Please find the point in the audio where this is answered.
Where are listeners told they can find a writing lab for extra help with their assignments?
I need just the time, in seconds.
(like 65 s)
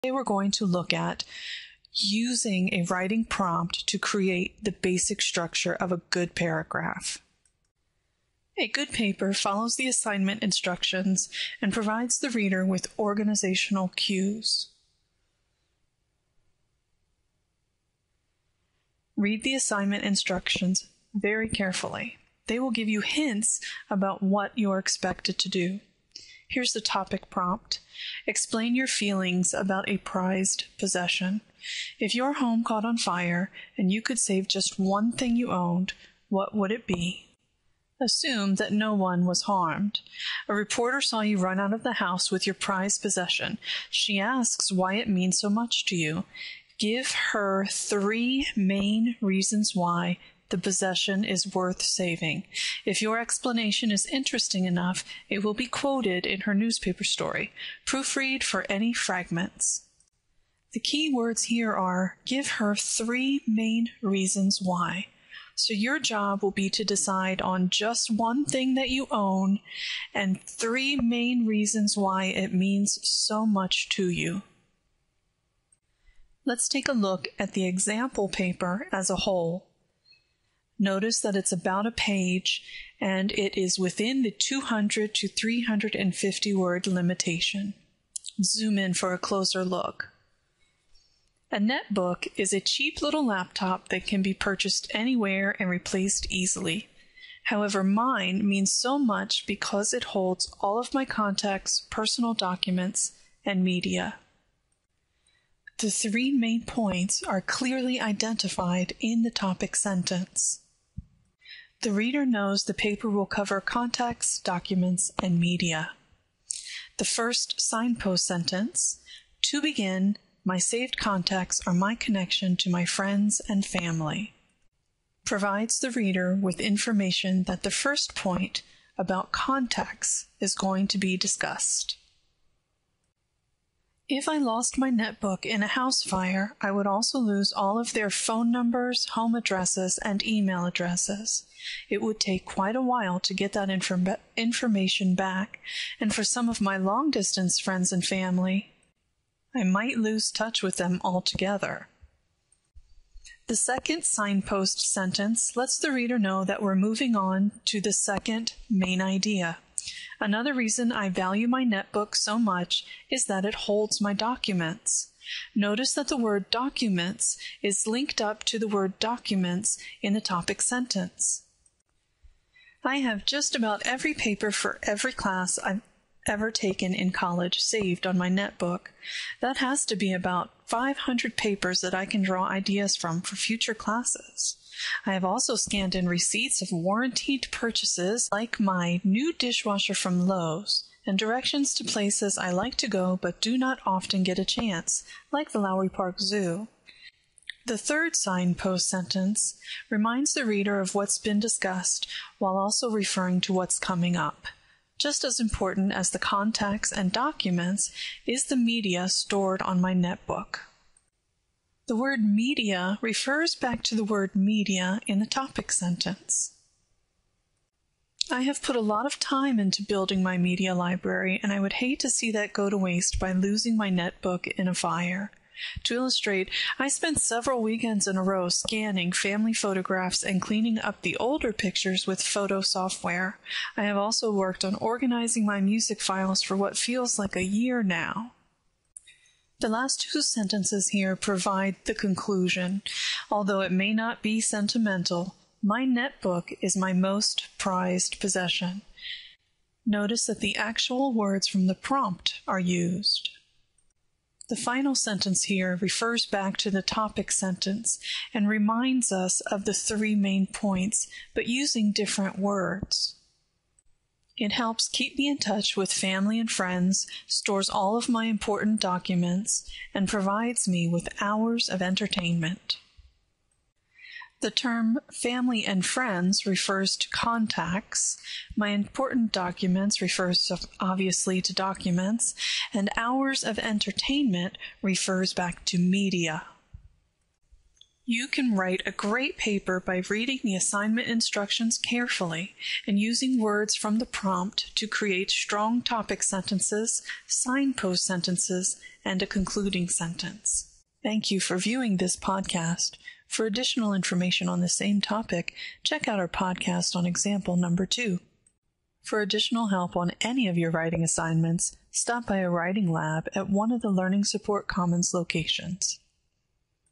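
313 s.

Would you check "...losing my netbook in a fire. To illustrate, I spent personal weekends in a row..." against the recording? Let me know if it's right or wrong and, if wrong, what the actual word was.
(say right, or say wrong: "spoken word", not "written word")
wrong: "several", not "personal".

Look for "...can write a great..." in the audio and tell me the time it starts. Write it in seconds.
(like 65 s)
288 s.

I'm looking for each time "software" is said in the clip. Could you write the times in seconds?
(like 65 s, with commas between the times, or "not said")
232 s.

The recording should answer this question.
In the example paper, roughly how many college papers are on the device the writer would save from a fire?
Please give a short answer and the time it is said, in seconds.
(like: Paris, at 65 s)
500, at 180 s.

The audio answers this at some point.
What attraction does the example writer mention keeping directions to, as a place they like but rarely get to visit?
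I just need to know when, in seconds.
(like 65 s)
195 s.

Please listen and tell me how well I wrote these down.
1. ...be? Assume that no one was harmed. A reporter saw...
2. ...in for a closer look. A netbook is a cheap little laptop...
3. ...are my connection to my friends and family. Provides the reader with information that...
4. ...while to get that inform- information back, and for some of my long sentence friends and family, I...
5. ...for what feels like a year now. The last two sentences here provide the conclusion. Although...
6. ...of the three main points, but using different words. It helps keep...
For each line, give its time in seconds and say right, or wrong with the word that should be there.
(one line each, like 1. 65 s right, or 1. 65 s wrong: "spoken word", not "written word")
1. 36 s right
2. 88 s right
3. 121 s right
4. 142 s wrong: "distance", not "sentence"
5. 236 s right
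6. 259 s right.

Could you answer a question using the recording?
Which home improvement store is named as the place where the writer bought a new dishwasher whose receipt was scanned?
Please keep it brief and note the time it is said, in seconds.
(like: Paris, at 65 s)
Lowe's, at 190 s.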